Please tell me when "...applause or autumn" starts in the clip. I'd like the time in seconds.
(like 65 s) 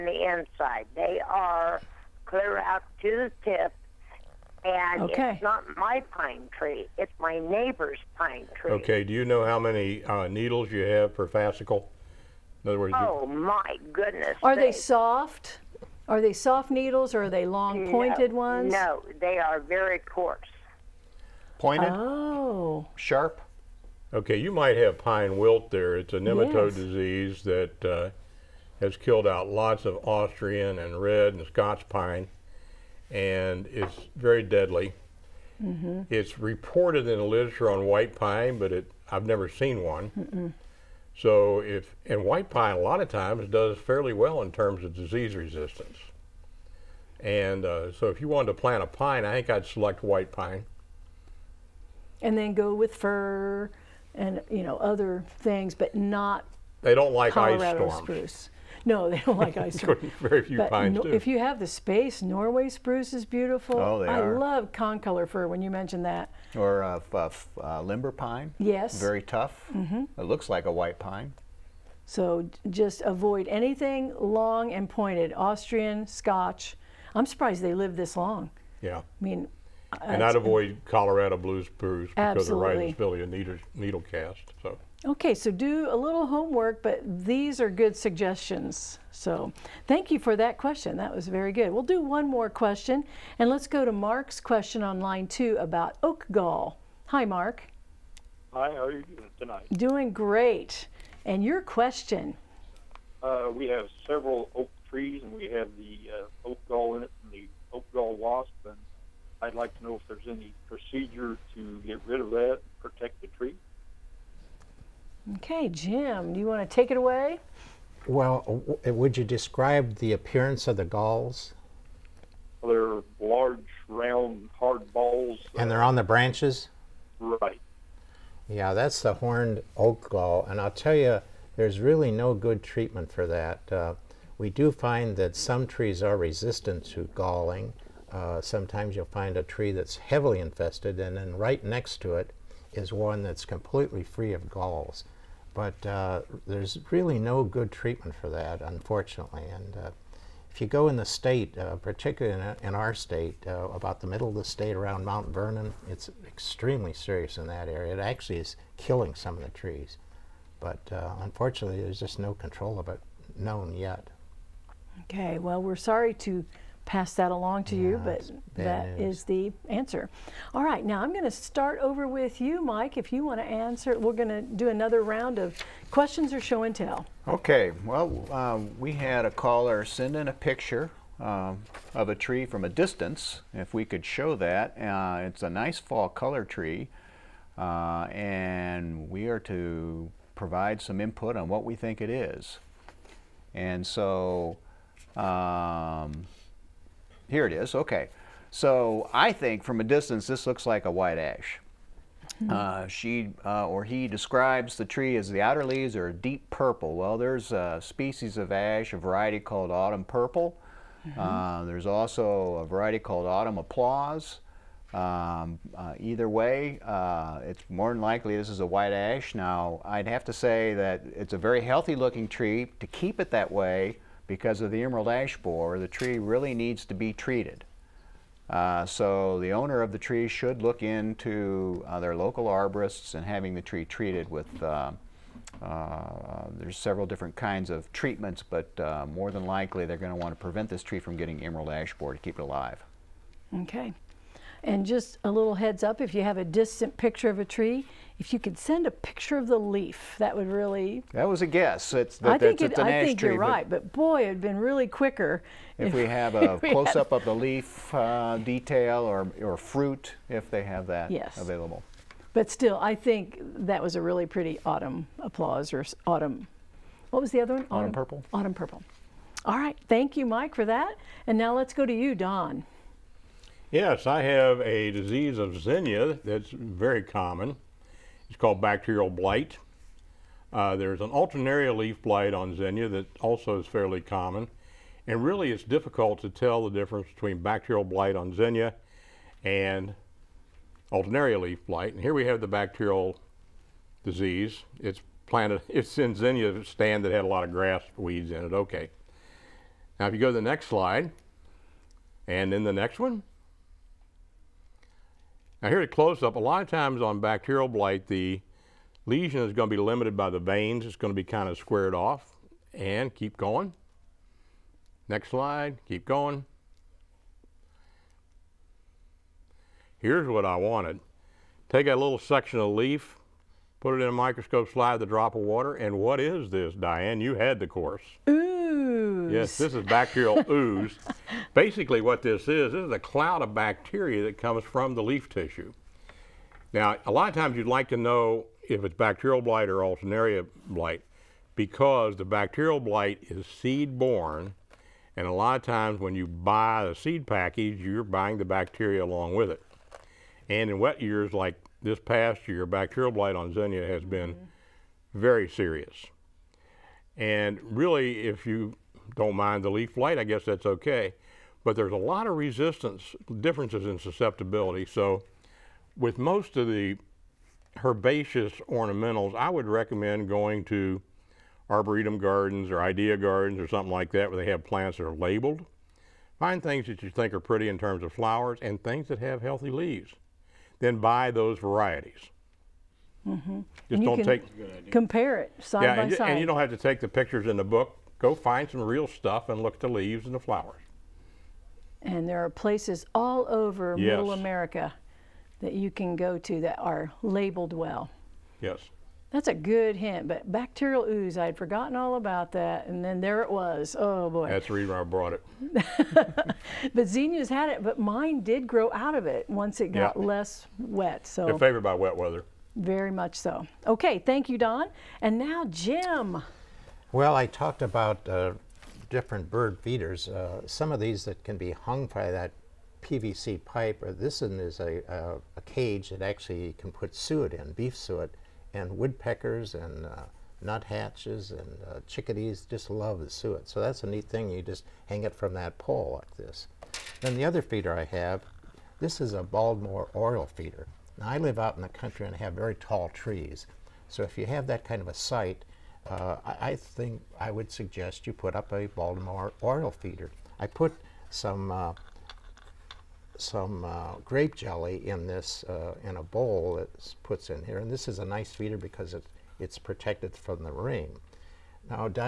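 265 s.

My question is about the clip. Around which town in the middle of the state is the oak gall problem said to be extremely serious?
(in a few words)
Mount Vernon.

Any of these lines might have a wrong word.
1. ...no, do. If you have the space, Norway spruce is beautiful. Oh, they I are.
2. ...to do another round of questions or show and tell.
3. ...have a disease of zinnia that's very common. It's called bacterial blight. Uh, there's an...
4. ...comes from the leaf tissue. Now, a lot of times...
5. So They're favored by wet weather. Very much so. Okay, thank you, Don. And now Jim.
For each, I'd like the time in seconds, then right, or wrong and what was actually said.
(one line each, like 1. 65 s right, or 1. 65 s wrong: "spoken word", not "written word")
1. 60 s right
2. 174 s right
3. 274 s right
4. 334 s right
5. 411 s right.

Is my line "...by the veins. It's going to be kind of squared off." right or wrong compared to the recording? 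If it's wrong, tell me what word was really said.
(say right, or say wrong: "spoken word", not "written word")
right.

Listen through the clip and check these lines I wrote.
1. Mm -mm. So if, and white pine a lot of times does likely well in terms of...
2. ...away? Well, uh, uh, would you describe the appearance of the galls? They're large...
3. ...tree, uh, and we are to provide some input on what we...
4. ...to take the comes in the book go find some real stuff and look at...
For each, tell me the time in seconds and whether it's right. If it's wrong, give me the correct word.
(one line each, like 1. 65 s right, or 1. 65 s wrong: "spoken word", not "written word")
1. 40 s wrong: "fairly", not "likely"
2. 116 s right
3. 186 s right
4. 386 s wrong: "pictures", not "comes".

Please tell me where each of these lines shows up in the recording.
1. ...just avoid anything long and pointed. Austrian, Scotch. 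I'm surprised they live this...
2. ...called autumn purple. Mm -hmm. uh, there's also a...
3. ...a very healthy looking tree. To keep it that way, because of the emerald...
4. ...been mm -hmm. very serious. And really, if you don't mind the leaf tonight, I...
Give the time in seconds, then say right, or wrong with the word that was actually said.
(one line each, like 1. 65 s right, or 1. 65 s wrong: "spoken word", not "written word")
1. 72 s right
2. 209 s right
3. 221 s right
4. 354 s wrong: "blight", not "tonight".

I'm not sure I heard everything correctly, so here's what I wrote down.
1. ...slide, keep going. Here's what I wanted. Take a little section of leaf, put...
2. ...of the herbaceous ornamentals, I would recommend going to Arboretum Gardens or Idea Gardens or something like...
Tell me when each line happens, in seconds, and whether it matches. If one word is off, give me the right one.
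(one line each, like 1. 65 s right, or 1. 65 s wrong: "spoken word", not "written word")
1. 315 s right
2. 366 s right.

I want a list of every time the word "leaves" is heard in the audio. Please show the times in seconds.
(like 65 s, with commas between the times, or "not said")
205 s, 379 s, 389 s.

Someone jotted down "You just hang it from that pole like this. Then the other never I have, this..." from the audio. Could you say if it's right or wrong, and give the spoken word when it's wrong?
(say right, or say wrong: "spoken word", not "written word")
wrong: "feeder", not "never".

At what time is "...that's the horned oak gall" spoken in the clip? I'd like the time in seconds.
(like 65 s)
128 s.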